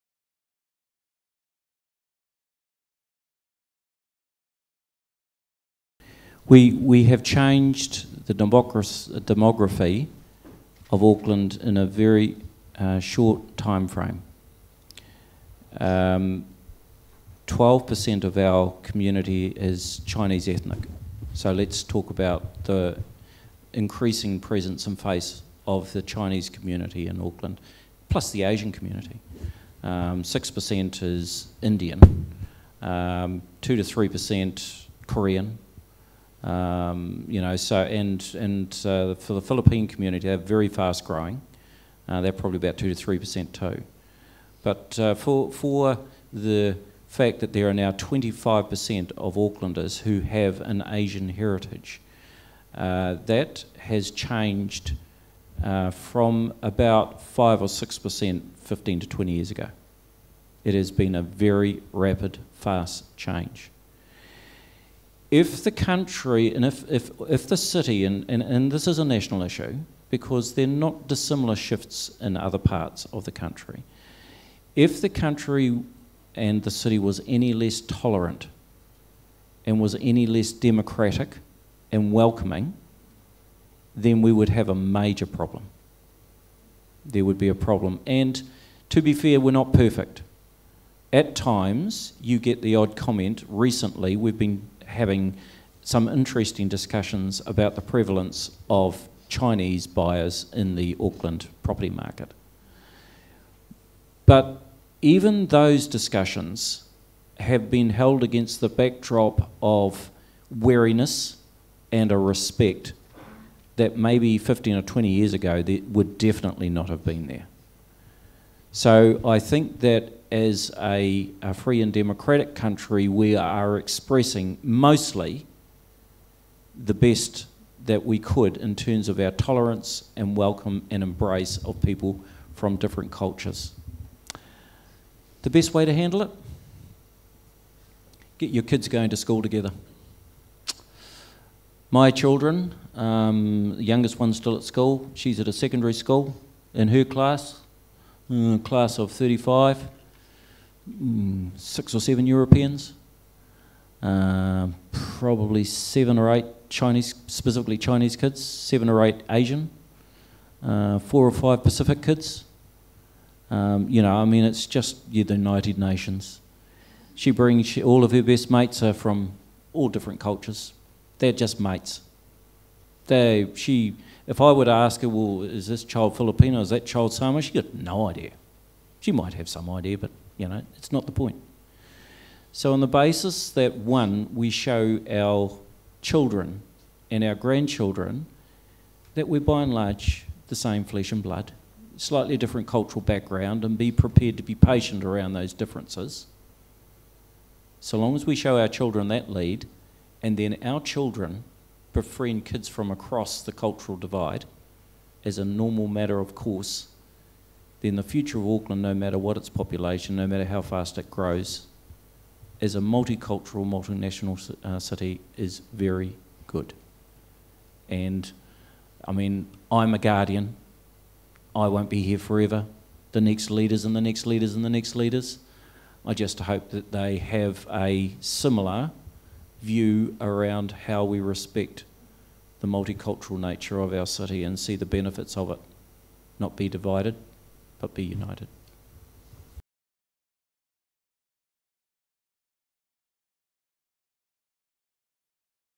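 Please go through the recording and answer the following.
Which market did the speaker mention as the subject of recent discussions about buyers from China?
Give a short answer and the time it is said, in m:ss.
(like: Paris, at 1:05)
Auckland property market, at 1:40.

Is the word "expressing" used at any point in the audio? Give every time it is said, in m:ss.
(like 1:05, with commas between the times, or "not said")
2:03.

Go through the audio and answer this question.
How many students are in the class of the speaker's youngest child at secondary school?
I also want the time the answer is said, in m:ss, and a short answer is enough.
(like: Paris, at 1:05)
35, at 2:29.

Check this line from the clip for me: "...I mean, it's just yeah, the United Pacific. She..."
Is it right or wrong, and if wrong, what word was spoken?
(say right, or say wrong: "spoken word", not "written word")
wrong: "Nations", not "Pacific".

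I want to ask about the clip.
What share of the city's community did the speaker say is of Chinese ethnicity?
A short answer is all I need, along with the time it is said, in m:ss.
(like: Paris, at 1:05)
12%, at 0:15.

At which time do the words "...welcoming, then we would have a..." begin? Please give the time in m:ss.
1:22.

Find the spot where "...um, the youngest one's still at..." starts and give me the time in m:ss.
2:22.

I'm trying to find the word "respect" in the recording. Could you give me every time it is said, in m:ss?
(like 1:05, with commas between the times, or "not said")
1:52, 3:51.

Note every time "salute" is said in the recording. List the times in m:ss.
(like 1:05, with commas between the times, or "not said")
not said.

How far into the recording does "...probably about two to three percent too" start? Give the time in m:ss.
0:42.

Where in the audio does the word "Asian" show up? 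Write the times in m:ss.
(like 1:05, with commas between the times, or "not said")
0:28, 0:50, 2:39.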